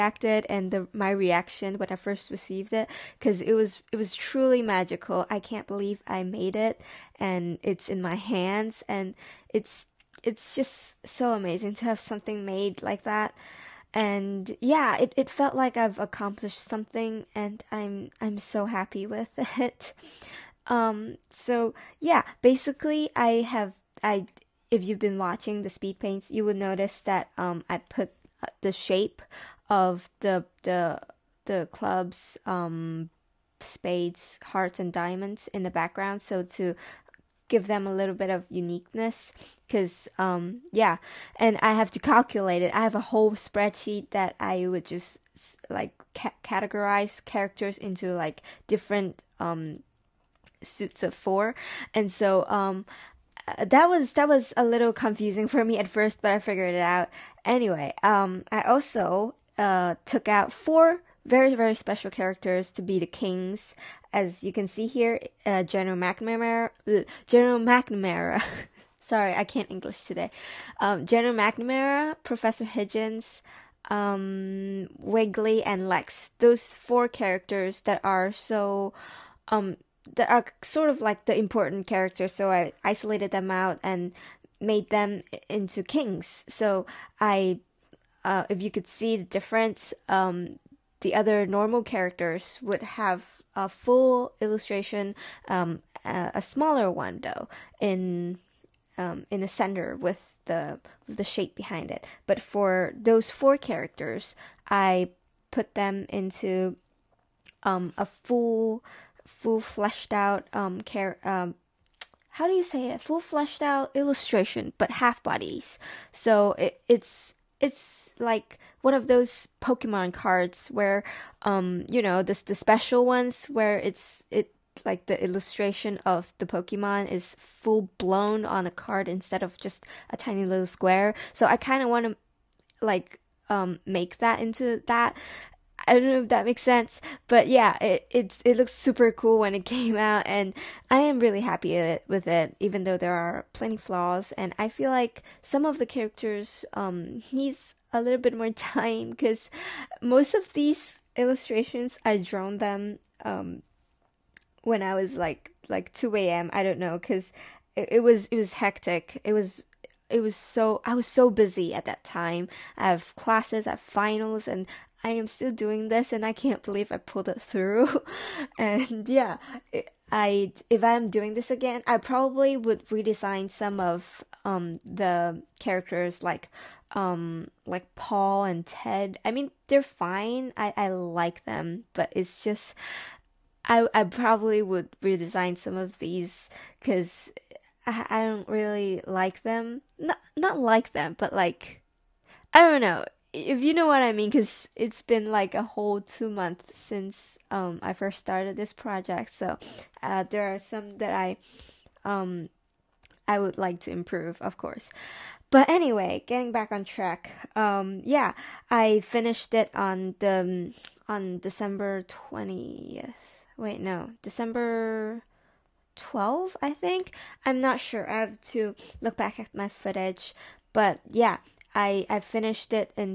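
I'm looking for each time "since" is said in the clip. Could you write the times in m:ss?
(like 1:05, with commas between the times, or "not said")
3:16.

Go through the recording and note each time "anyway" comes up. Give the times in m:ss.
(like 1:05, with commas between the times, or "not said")
0:57, 3:25.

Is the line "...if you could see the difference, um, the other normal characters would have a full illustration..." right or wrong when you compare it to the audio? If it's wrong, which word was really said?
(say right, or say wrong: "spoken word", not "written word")
right.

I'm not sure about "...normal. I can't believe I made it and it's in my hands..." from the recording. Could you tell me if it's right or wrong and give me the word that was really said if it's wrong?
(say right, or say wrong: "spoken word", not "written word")
wrong: "magical", not "normal".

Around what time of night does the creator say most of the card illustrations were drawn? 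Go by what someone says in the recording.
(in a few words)
2 a.m.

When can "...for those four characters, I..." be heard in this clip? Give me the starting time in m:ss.
1:42.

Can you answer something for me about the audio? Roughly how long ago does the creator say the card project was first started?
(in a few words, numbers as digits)
2 months.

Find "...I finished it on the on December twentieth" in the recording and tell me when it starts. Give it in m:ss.
3:28.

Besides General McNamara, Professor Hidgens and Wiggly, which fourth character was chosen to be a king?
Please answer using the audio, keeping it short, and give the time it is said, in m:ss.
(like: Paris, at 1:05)
Lex, at 1:15.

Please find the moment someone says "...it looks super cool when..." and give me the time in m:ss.
2:18.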